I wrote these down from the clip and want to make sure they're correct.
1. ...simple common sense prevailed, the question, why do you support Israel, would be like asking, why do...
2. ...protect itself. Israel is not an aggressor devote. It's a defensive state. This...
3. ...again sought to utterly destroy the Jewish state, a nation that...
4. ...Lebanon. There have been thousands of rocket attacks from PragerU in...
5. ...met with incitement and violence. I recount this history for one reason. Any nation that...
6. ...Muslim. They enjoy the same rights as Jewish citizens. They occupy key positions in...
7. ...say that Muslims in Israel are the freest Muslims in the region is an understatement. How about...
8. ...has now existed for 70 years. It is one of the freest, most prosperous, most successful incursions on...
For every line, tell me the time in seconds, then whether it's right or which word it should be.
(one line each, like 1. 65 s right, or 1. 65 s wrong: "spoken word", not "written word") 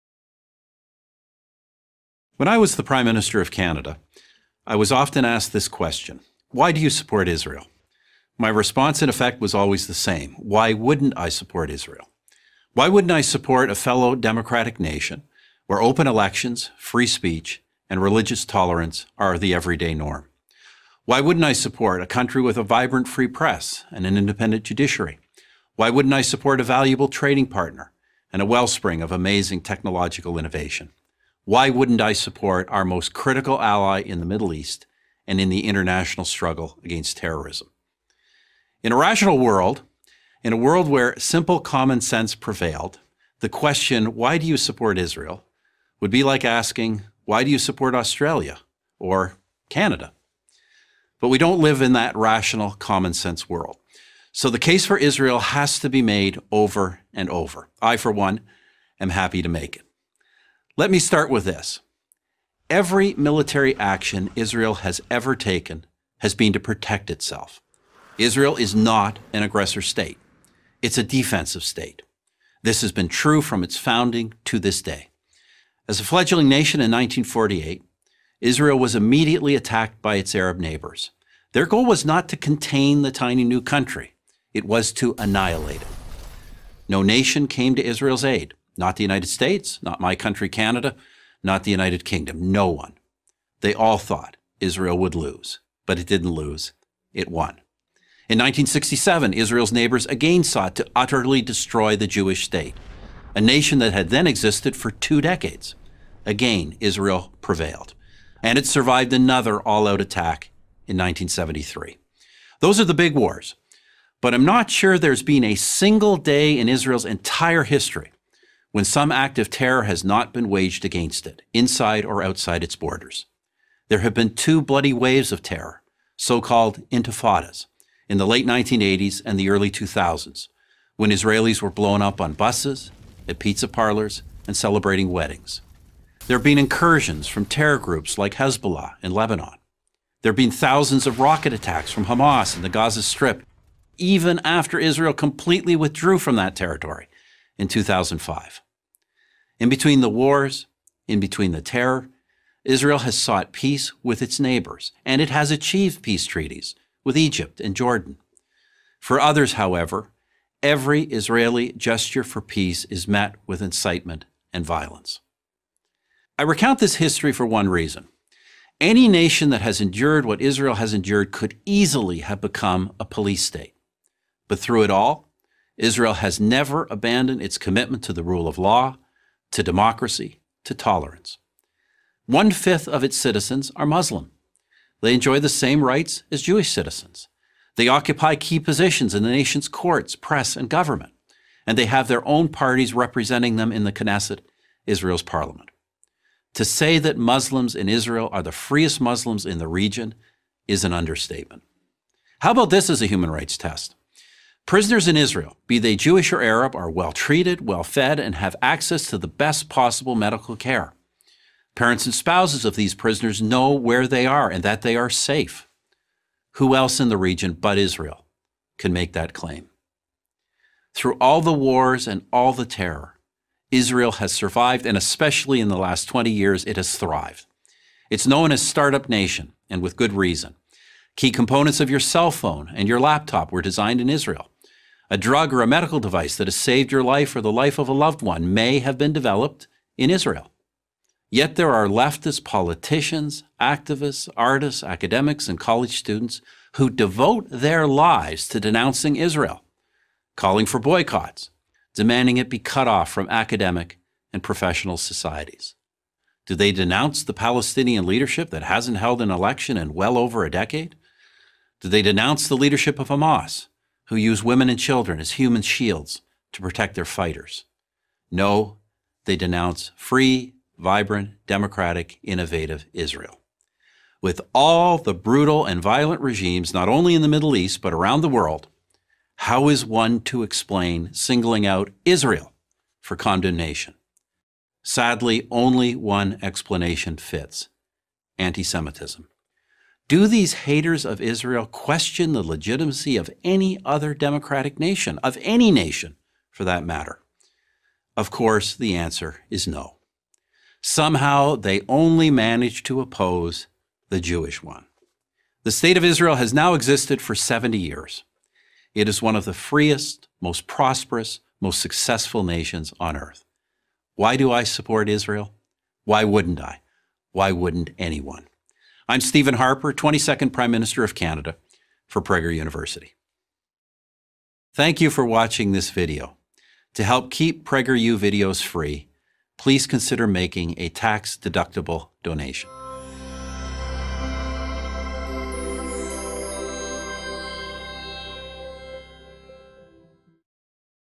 1. 41 s right
2. 66 s wrong: "state", not "devote"
3. 100 s right
4. 139 s wrong: "Hamas", not "PragerU"
5. 163 s right
6. 183 s right
7. 196 s right
8. 306 s wrong: "nations", not "incursions".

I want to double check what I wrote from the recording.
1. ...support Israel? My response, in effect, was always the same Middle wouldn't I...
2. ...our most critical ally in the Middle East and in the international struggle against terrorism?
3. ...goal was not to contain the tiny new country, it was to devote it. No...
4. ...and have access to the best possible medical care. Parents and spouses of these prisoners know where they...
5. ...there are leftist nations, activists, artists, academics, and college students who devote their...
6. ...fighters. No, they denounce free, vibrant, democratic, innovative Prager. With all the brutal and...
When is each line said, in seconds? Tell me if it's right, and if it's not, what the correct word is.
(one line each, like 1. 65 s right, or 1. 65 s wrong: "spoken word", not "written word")
1. 6 s wrong: "Why", not "Middle"
2. 32 s right
3. 81 s wrong: "annihilate", not "devote"
4. 208 s right
5. 241 s wrong: "politicians", not "nations"
6. 267 s wrong: "Israel", not "Prager".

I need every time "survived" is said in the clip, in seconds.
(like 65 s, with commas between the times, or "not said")
108 s, 224 s.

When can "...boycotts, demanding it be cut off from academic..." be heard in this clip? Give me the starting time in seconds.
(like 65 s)
250 s.